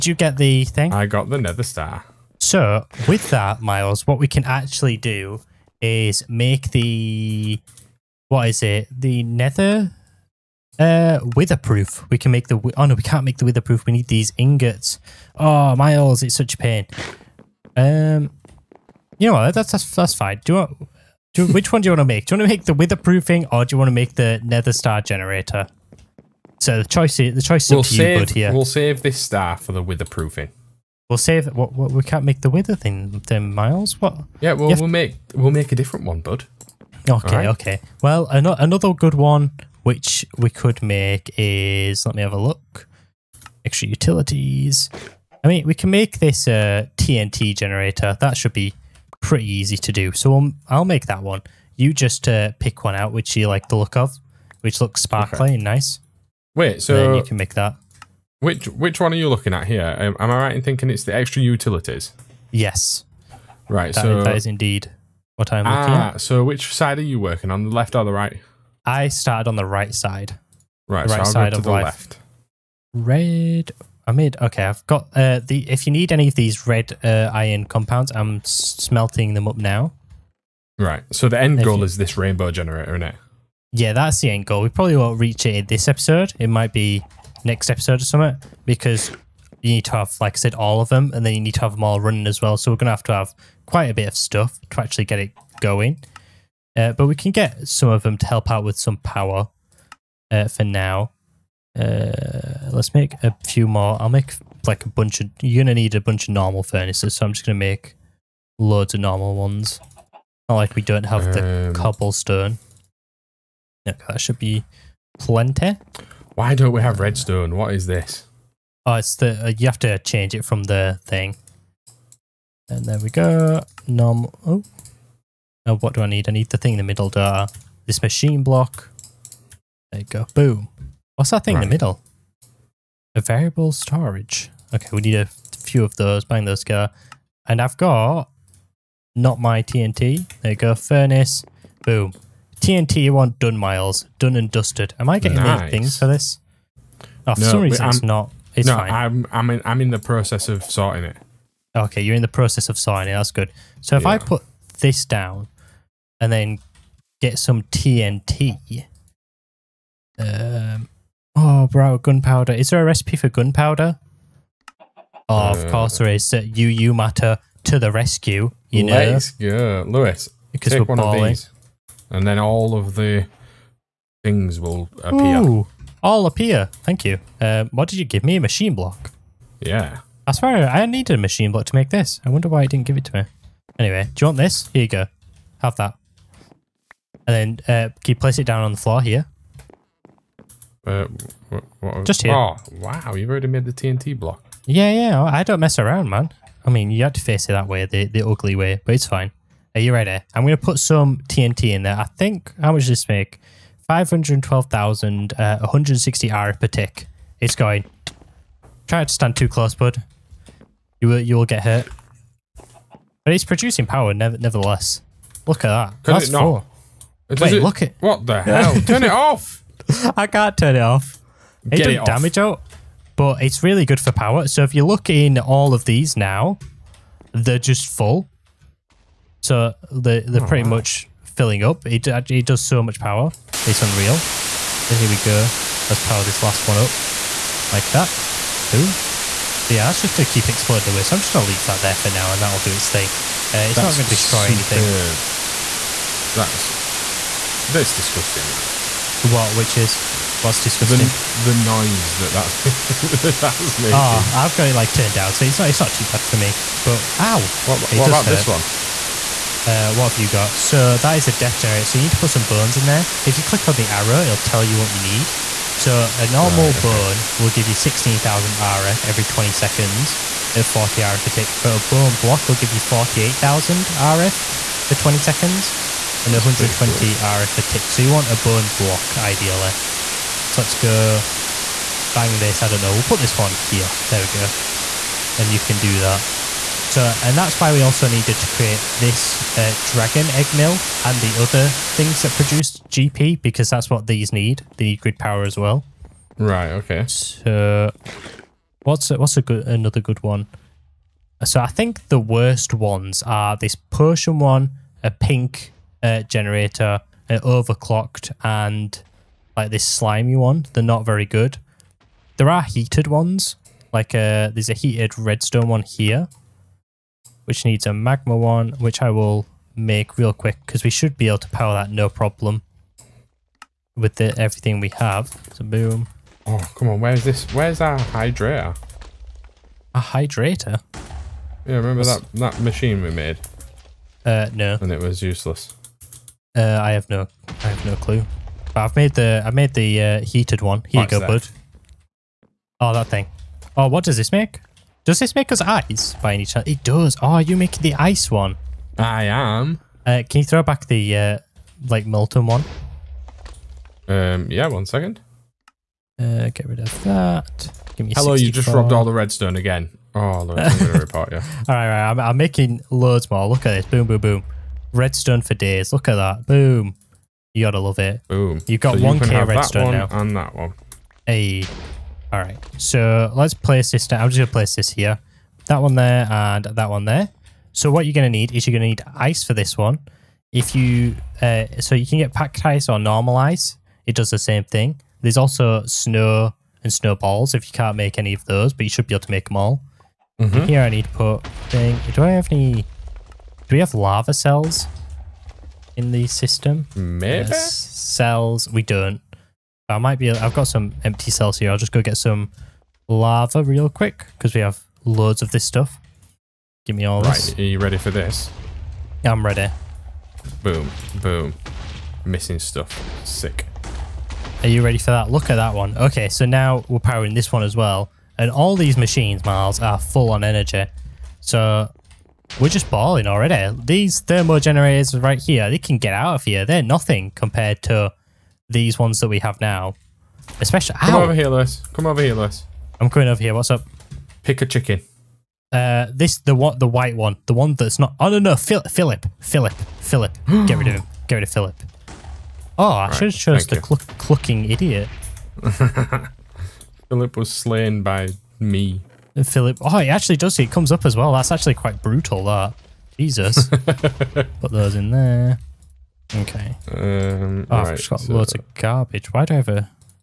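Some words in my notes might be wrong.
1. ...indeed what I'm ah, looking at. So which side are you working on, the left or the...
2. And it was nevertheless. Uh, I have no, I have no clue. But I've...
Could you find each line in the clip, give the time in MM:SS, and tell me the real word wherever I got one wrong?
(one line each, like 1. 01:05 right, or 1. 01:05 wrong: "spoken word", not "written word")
1. 01:04 right
2. 05:34 wrong: "useless", not "nevertheless".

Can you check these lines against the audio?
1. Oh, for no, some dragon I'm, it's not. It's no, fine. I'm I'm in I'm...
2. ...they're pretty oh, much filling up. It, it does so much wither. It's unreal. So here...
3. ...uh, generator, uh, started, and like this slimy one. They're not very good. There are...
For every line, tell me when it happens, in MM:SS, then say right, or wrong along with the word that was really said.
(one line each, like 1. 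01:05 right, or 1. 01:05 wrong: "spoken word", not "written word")
1. 02:27 wrong: "reason", not "dragon"
2. 03:50 wrong: "power", not "wither"
3. 05:06 wrong: "overclocked", not "started".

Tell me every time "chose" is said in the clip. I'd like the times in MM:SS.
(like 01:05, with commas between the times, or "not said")
07:23.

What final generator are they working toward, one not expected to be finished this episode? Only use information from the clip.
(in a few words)
rainbow generator.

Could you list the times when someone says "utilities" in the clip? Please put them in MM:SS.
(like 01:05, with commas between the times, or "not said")
00:43, 01:01.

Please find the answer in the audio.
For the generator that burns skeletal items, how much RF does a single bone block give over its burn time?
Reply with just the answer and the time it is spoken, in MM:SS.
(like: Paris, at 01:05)
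48,000, at 04:32.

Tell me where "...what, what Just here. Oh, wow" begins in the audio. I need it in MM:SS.
03:11.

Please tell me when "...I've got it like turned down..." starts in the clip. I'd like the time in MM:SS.
04:14.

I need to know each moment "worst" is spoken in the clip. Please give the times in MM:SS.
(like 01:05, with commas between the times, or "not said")
05:02.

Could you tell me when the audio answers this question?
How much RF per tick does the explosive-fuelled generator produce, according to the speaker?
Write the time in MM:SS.
03:26.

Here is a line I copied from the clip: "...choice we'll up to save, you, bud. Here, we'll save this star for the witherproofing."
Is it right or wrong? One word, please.
right.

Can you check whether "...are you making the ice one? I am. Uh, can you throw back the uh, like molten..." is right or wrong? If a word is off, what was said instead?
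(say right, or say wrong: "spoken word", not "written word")
right.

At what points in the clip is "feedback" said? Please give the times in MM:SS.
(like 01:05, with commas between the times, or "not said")
not said.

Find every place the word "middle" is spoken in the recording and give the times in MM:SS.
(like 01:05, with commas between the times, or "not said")
02:06, 02:11.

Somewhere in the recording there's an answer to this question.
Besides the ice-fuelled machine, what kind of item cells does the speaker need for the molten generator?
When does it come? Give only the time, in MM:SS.
06:33.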